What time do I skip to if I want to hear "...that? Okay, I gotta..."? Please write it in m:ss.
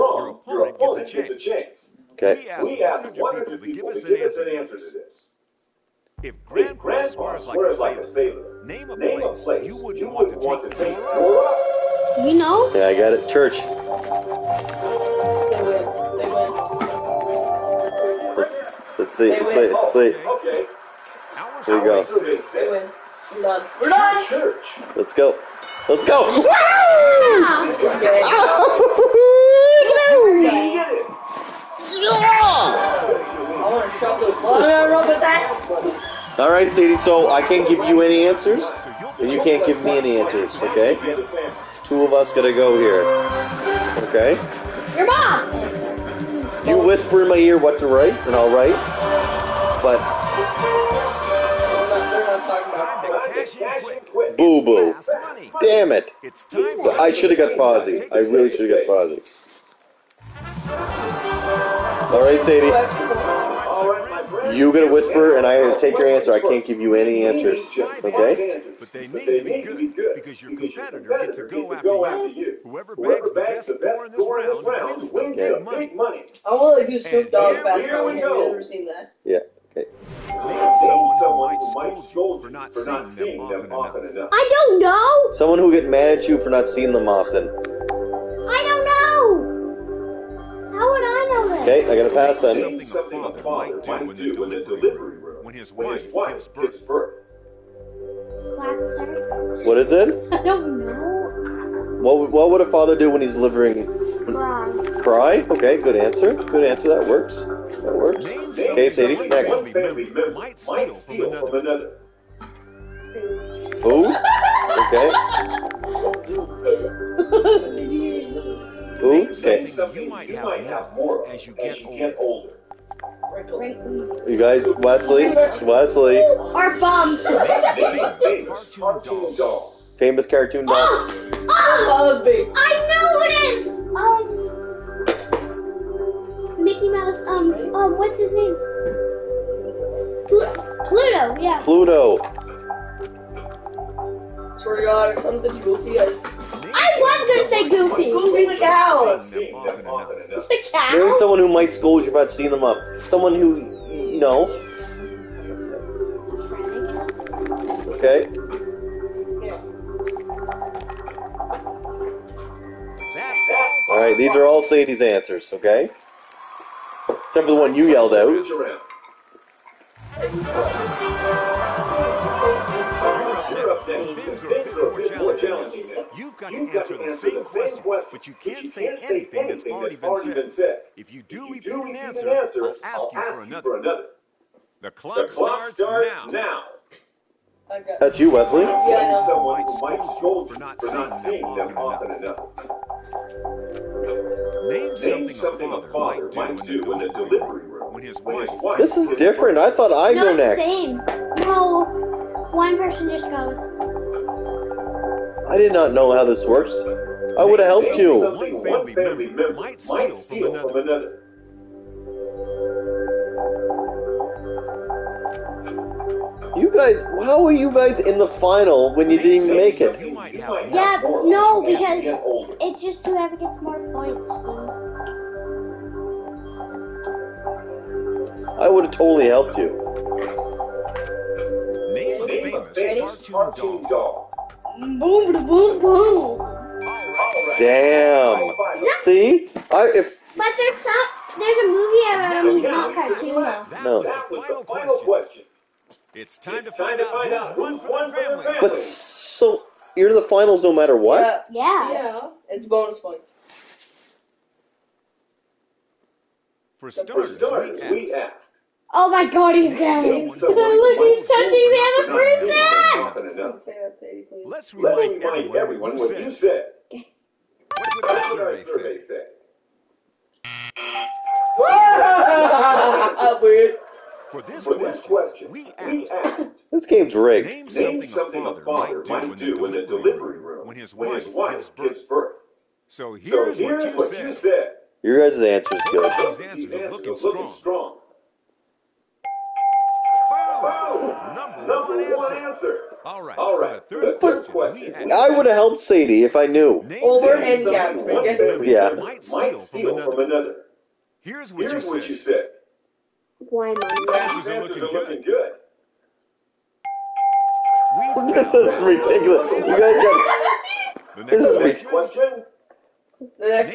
1:31.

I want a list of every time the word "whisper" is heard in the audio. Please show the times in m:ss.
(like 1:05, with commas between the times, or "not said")
0:46, 1:04.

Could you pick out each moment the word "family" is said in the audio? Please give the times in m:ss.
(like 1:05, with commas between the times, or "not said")
1:49, 4:08.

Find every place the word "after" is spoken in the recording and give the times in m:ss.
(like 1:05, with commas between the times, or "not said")
1:12.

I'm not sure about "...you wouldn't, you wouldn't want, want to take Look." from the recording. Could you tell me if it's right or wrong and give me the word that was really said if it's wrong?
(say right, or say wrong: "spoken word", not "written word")
wrong: "Nora", not "Look".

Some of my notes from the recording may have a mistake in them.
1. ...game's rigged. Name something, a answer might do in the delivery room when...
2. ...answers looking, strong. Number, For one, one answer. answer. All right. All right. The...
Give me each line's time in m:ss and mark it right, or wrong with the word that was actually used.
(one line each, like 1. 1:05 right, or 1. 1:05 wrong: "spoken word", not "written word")
1. 4:36 wrong: "father", not "answer"
2. 4:46 wrong: "Number", not "For".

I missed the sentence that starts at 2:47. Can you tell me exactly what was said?
Except for the one you yelled out.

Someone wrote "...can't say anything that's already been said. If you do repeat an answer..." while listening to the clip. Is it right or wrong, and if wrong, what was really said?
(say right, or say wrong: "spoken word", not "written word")
right.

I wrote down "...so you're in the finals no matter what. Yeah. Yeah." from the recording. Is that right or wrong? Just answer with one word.
right.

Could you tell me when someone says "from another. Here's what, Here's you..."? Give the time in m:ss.
5:00.